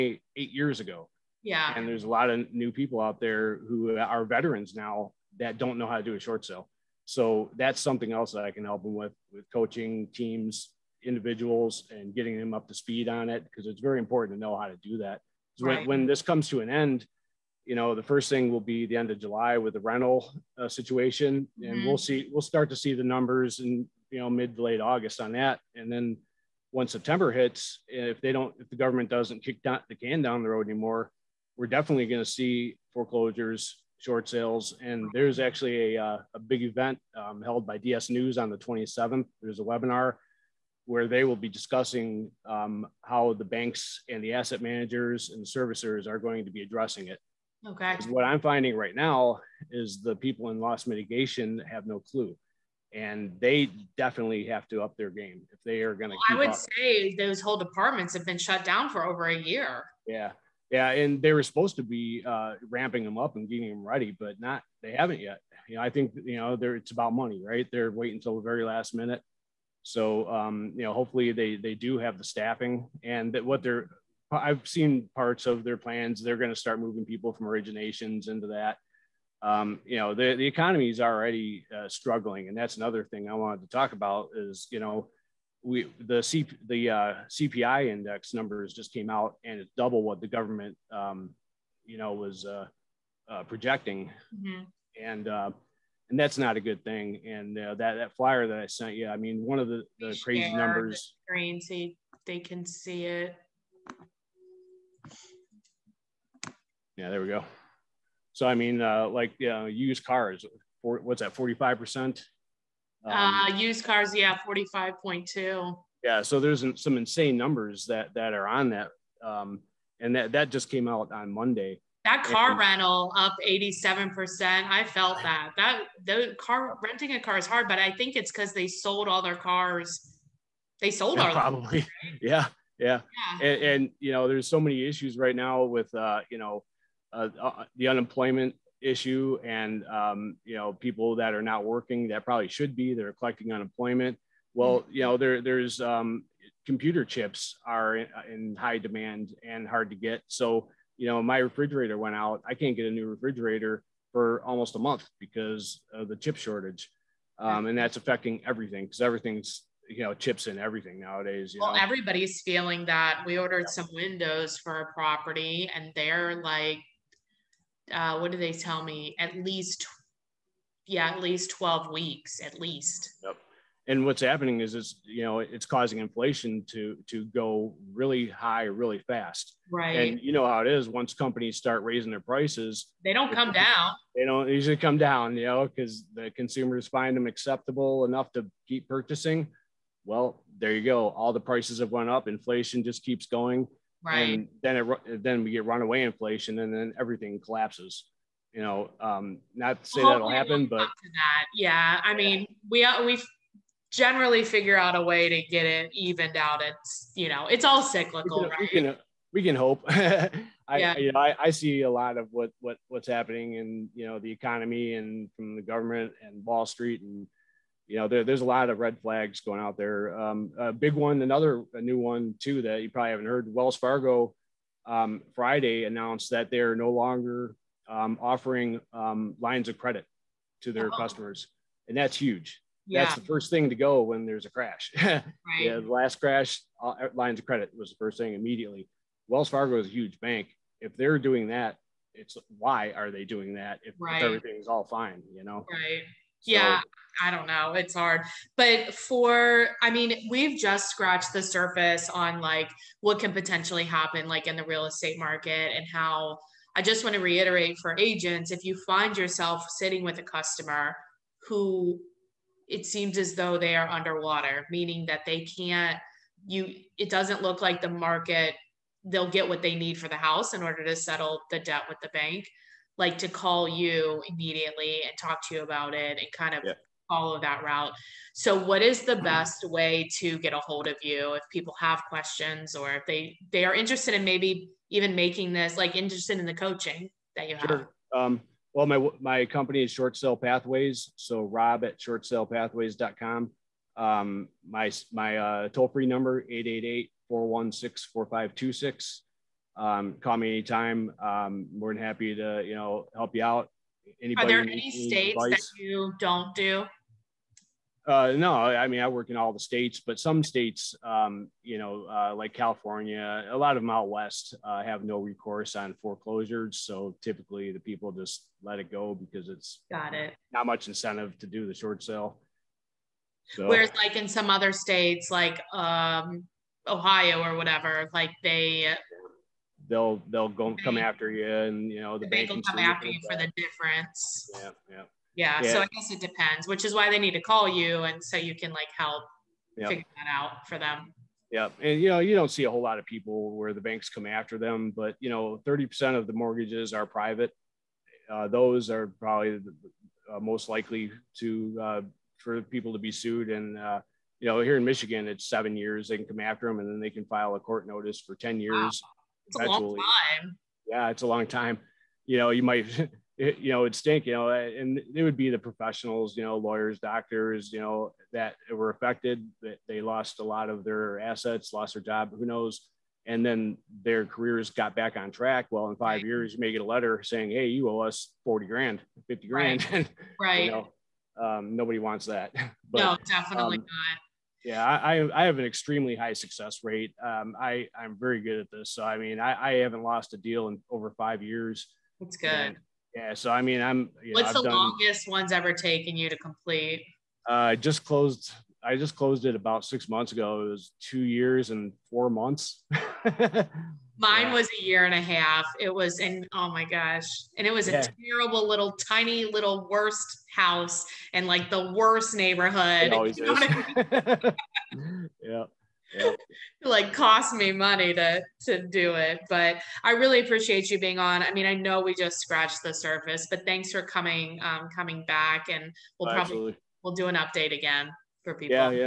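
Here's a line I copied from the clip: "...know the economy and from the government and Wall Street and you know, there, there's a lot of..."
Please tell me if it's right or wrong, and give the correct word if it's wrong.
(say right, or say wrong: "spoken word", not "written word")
right.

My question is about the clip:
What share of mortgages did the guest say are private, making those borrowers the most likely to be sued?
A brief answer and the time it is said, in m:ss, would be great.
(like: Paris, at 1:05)
30%, at 5:45.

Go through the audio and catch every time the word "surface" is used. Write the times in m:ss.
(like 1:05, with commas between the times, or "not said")
4:11, 7:02.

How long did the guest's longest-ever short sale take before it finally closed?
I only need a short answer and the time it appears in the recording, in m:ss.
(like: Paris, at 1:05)
2 years and 4 months, at 6:40.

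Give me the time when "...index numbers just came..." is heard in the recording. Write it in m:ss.
1:27.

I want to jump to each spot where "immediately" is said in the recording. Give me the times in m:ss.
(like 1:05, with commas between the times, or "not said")
3:58, 4:34.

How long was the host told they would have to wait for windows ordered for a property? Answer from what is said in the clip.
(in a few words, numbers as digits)
12 weeks.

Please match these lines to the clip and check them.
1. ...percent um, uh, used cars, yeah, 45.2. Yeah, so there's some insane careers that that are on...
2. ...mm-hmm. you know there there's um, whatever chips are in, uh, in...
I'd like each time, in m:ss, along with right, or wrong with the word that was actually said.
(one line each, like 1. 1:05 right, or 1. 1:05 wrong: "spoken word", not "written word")
1. 1:51 wrong: "numbers", not "careers"
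2. 2:24 wrong: "computer", not "whatever".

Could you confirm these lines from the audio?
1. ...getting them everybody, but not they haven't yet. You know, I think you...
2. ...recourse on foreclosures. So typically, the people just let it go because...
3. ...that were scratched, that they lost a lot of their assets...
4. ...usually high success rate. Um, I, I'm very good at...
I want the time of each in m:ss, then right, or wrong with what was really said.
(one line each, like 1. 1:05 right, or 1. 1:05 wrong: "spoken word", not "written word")
1. 1:03 wrong: "ready", not "everybody"
2. 5:15 right
3. 6:08 wrong: "affected", not "scratched"
4. 6:25 wrong: "extremely", not "usually".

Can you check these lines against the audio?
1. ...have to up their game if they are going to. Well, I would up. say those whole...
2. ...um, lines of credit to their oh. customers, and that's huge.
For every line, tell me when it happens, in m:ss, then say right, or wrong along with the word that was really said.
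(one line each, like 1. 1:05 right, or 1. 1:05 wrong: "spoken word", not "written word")
1. 0:54 right
2. 3:48 right.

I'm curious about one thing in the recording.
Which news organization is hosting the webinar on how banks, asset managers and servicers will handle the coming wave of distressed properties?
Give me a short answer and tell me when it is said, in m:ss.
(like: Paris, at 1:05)
DS News, at 0:37.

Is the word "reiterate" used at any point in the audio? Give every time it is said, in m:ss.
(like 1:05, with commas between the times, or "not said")
4:17.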